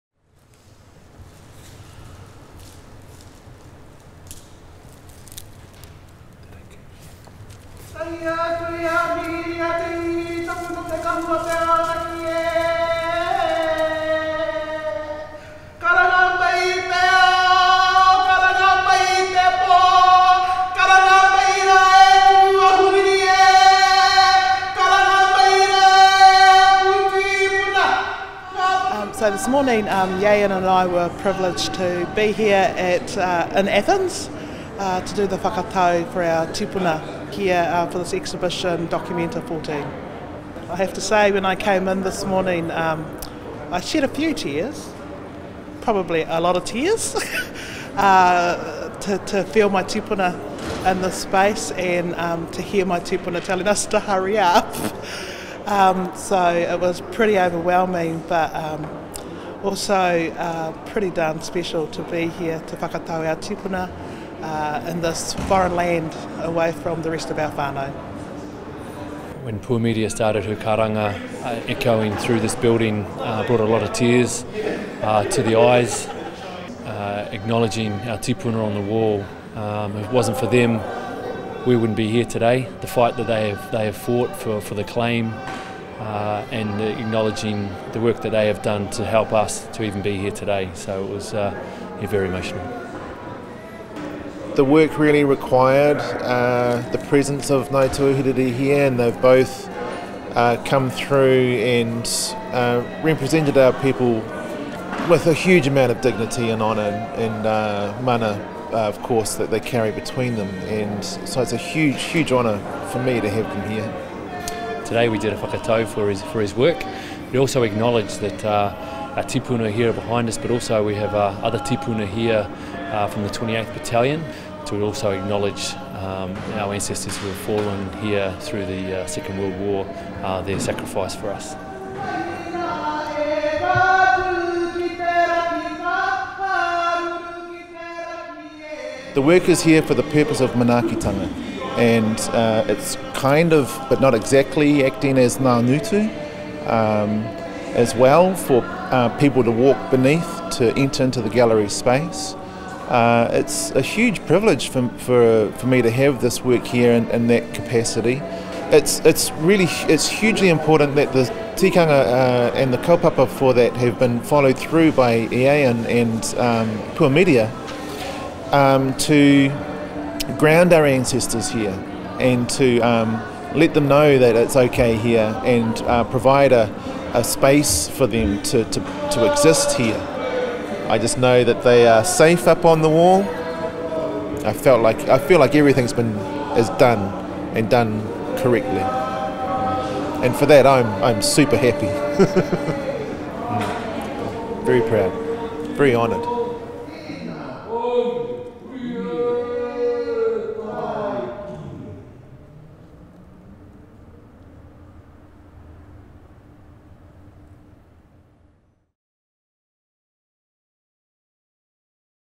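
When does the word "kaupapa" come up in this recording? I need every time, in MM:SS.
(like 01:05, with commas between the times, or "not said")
02:42.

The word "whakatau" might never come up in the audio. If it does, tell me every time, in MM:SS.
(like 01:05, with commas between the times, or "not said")
00:35, 01:02, 01:55.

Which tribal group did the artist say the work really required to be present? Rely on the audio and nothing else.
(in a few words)
Ngāi Tūāhuriri.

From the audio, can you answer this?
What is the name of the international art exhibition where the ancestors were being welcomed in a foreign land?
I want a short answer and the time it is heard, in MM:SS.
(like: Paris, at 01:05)
Documenta 14, at 00:38.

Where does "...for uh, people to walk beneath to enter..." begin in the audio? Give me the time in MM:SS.
02:28.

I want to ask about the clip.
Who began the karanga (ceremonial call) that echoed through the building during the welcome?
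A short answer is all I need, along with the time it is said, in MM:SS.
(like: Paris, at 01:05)
Puamiria, at 01:09.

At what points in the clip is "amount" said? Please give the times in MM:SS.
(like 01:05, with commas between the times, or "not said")
01:45.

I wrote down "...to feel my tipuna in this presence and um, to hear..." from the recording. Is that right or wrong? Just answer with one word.
wrong.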